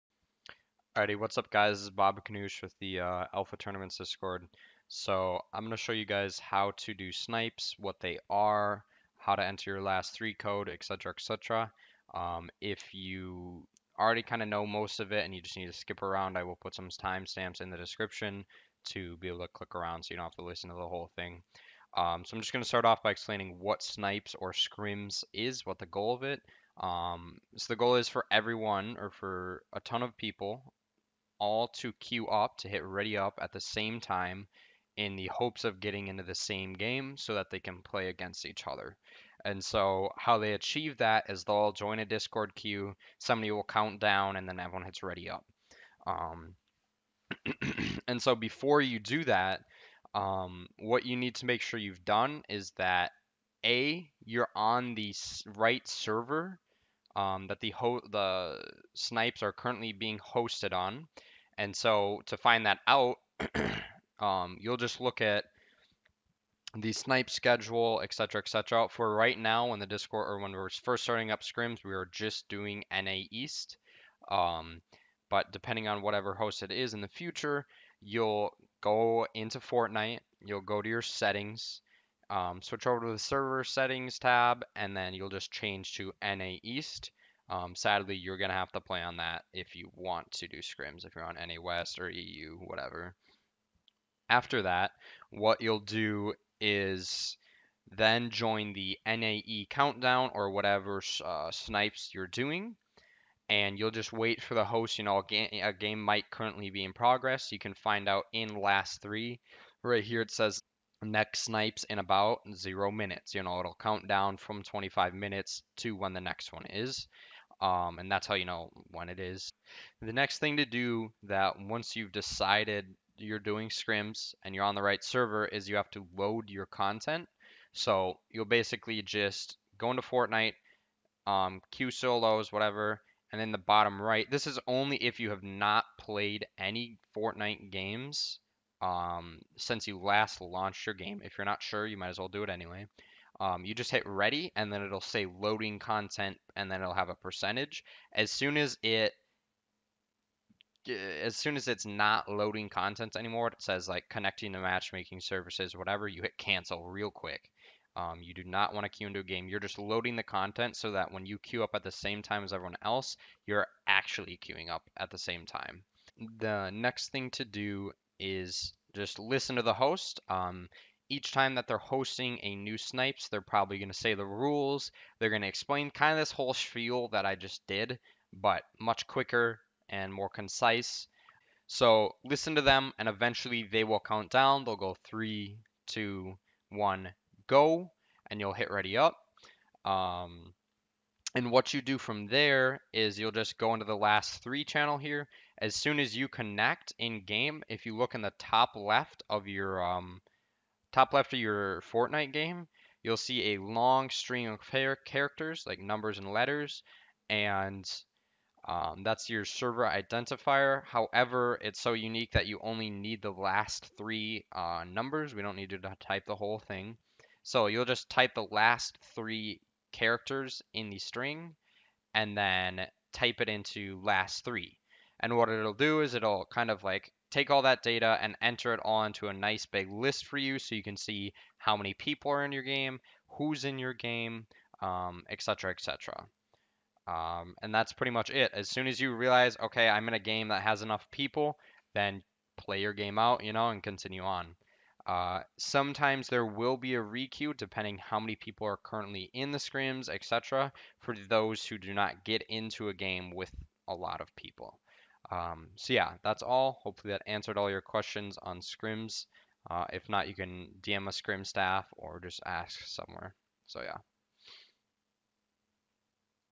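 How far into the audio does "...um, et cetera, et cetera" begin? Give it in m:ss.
3:54.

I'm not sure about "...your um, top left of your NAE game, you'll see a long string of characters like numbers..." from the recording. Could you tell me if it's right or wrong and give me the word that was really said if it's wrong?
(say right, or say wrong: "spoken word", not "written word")
wrong: "Fortnite", not "NAE".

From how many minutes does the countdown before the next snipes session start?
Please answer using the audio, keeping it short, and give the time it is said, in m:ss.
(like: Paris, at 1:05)
25, at 1:54.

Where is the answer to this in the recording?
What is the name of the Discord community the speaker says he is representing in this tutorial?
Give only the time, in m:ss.
0:03.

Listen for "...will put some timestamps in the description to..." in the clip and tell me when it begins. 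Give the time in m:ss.
0:16.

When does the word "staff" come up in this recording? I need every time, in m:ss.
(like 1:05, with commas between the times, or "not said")
4:21.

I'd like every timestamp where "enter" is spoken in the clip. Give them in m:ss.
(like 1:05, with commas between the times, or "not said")
0:09, 3:48.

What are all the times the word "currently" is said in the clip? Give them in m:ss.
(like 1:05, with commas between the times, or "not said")
0:59, 1:46, 4:08.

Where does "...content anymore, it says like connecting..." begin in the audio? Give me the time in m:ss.
2:32.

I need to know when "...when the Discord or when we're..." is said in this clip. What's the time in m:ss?
1:09.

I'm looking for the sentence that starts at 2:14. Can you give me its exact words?
This is only if you have not played any Fortnite games um, since you last launched your game.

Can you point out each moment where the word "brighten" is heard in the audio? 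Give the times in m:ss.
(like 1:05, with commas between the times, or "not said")
not said.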